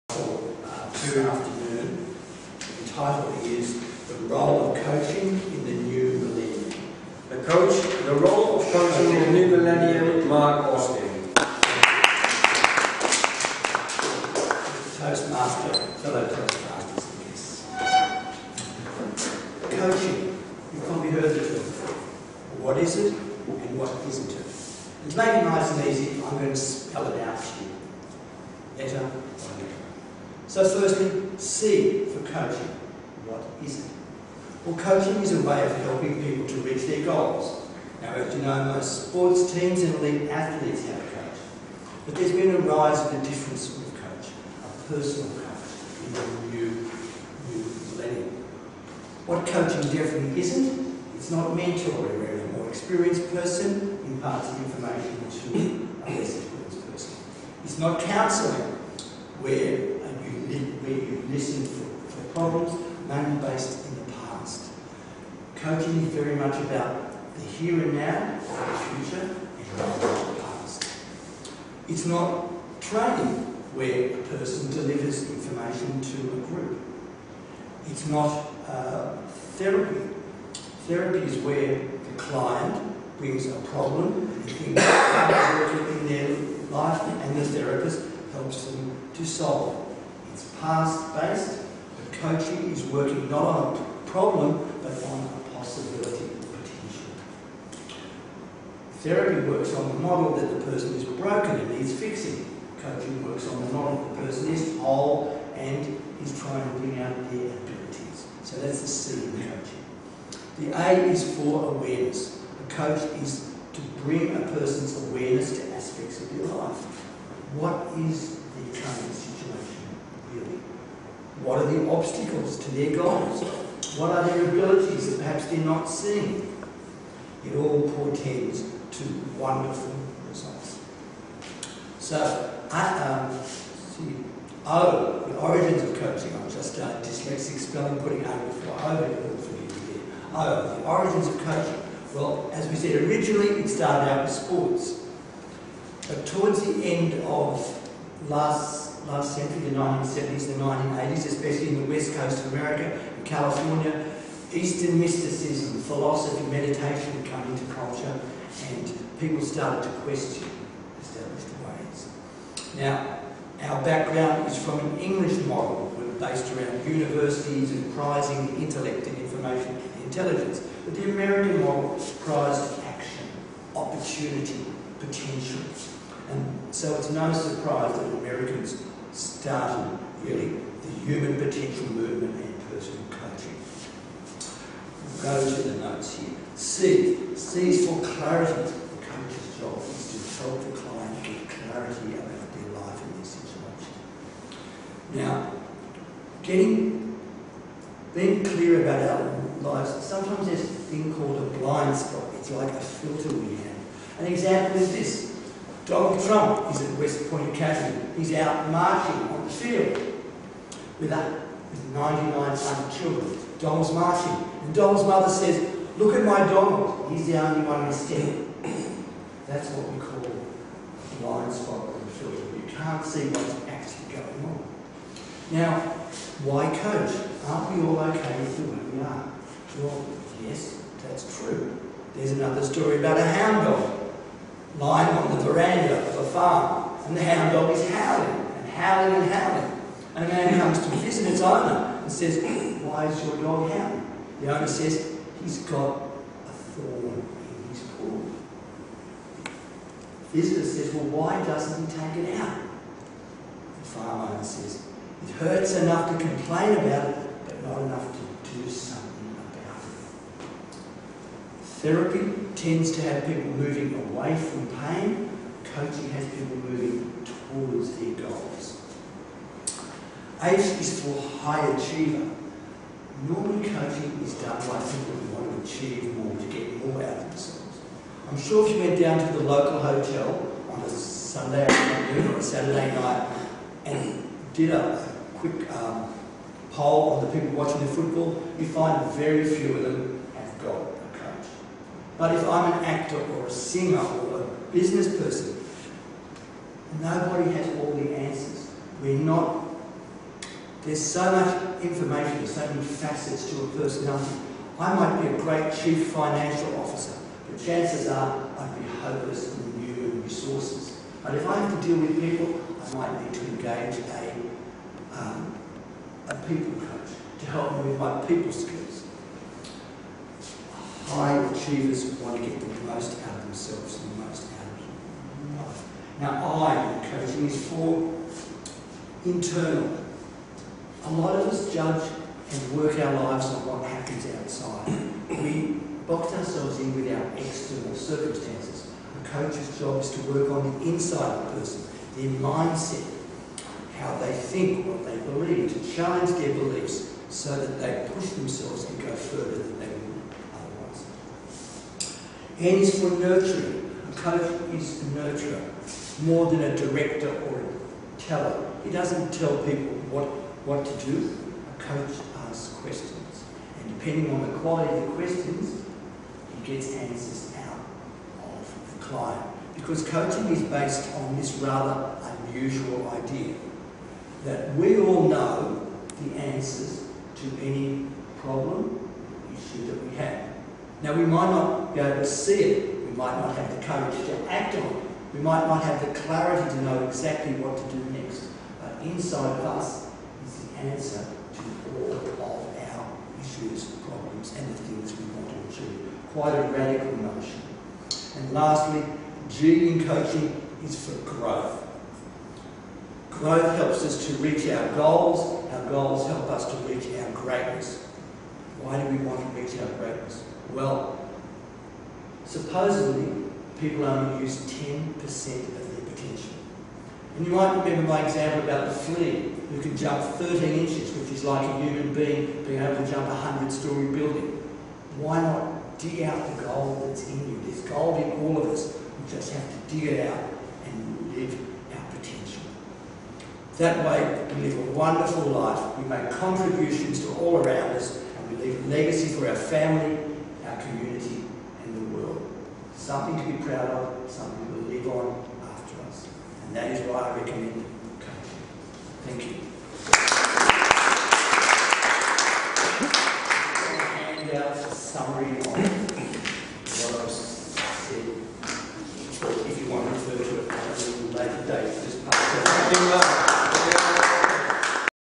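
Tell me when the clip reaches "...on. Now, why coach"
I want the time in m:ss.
3:44.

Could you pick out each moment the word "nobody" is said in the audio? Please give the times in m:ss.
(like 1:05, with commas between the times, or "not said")
4:57.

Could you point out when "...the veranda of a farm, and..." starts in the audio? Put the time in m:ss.
3:55.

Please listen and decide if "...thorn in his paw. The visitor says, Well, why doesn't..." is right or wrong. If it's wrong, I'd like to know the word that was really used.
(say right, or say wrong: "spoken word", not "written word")
right.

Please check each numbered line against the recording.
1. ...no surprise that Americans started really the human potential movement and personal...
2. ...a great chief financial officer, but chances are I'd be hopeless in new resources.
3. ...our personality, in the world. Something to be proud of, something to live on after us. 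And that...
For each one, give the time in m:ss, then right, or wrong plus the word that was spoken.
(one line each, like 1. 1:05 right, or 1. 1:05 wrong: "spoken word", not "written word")
1. 2:57 right
2. 5:05 right
3. 7:20 wrong: "community", not "personality".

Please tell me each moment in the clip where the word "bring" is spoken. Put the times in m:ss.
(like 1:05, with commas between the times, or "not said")
1:23, 1:46, 1:54.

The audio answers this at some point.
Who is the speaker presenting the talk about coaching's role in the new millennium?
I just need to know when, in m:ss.
0:10.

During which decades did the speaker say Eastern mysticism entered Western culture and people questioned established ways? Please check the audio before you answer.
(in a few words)
1970s and 1980s.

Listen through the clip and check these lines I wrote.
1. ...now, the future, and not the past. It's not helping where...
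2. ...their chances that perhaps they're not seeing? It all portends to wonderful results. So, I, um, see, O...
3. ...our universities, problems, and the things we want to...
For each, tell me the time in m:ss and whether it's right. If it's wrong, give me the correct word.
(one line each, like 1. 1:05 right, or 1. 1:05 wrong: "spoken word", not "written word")
1. 1:07 wrong: "training", not "helping"
2. 2:04 wrong: "abilities", not "chances"
3. 6:32 wrong: "issues", not "universities".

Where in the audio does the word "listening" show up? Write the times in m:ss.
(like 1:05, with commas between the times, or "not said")
1:00.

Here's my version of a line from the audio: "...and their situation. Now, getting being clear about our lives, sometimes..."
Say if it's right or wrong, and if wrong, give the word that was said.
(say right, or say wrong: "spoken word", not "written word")
right.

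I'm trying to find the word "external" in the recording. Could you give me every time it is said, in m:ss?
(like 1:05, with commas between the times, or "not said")
5:37.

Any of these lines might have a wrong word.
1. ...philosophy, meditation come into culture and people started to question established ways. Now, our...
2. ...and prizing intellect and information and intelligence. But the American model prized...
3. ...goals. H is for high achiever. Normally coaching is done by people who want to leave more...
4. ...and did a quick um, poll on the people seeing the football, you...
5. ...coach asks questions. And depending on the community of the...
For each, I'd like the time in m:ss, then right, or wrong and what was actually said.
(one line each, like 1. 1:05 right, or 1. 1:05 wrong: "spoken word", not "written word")
1. 2:35 right
2. 2:47 right
3. 4:28 wrong: "achieve", not "leave"
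4. 4:43 wrong: "watching", not "seeing"
5. 6:01 wrong: "quality", not "community".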